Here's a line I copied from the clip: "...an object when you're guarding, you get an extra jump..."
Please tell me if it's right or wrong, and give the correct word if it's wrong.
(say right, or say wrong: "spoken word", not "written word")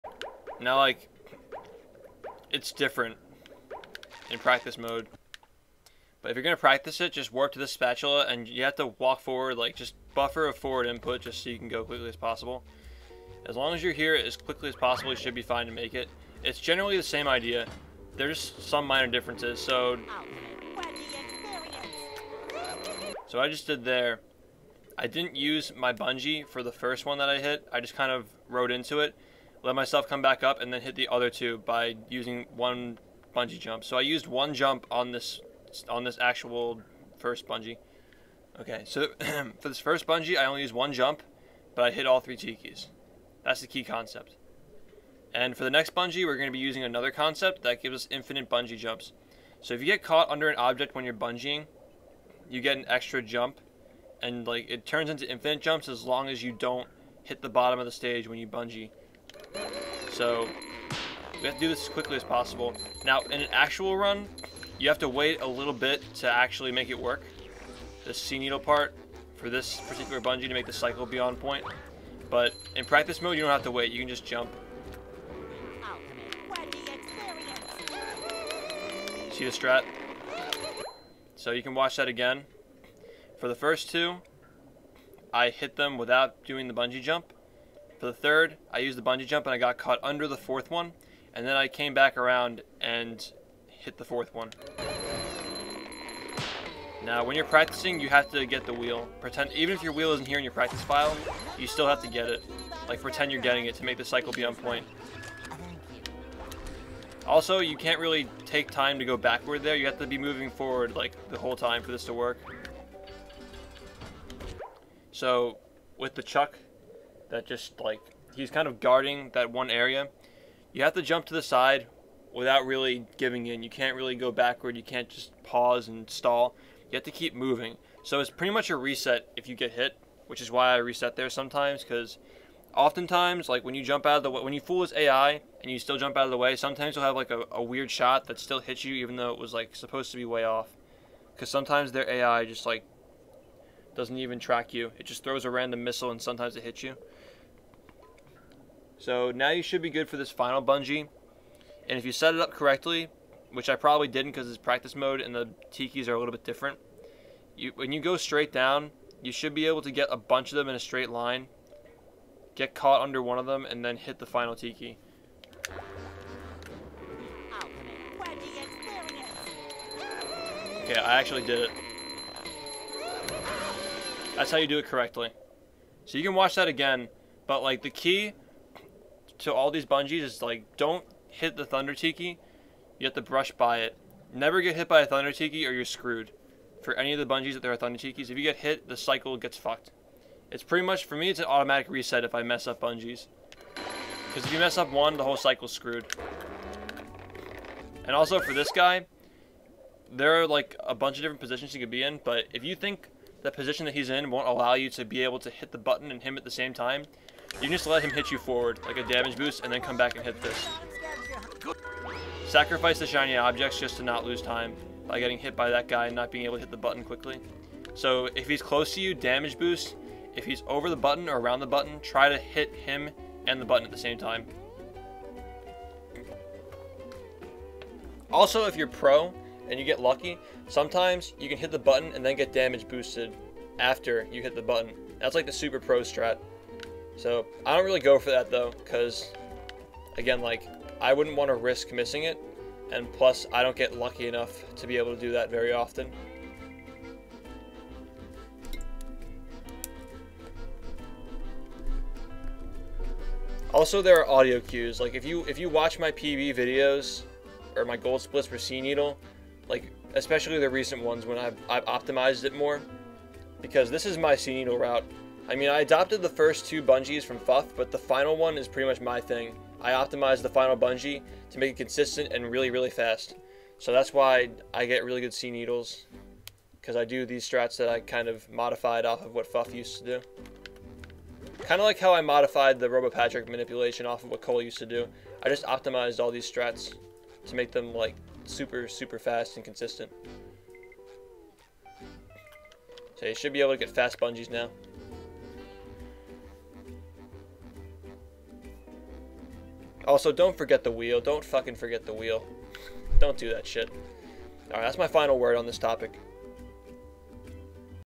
wrong: "bungeeing", not "guarding".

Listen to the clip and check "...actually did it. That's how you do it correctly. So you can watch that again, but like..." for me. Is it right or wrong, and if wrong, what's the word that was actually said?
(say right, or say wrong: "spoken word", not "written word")
right.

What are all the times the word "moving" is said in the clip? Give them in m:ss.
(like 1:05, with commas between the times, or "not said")
1:50, 2:07.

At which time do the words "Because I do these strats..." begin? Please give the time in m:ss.
4:36.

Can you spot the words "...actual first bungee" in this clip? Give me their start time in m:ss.
0:36.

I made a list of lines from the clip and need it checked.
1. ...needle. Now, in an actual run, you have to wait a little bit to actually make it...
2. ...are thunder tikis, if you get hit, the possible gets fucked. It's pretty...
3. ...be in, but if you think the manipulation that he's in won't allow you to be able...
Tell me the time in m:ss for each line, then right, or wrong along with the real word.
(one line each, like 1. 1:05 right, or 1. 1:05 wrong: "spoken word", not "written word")
1. 1:02 wrong: "possible", not "needle"
2. 3:07 wrong: "cycle", not "possible"
3. 3:21 wrong: "position", not "manipulation".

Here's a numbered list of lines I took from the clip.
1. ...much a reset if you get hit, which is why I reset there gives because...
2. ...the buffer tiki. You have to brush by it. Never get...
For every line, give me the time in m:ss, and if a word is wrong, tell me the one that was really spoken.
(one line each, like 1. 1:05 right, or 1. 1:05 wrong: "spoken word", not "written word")
1. 2:08 wrong: "sometimes", not "gives"
2. 3:01 wrong: "thunder", not "buffer".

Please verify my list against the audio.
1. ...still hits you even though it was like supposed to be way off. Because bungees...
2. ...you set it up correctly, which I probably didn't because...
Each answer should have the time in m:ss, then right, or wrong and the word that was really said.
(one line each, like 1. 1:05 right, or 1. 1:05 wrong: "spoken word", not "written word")
1. 2:18 wrong: "sometimes", not "bungees"
2. 2:32 right.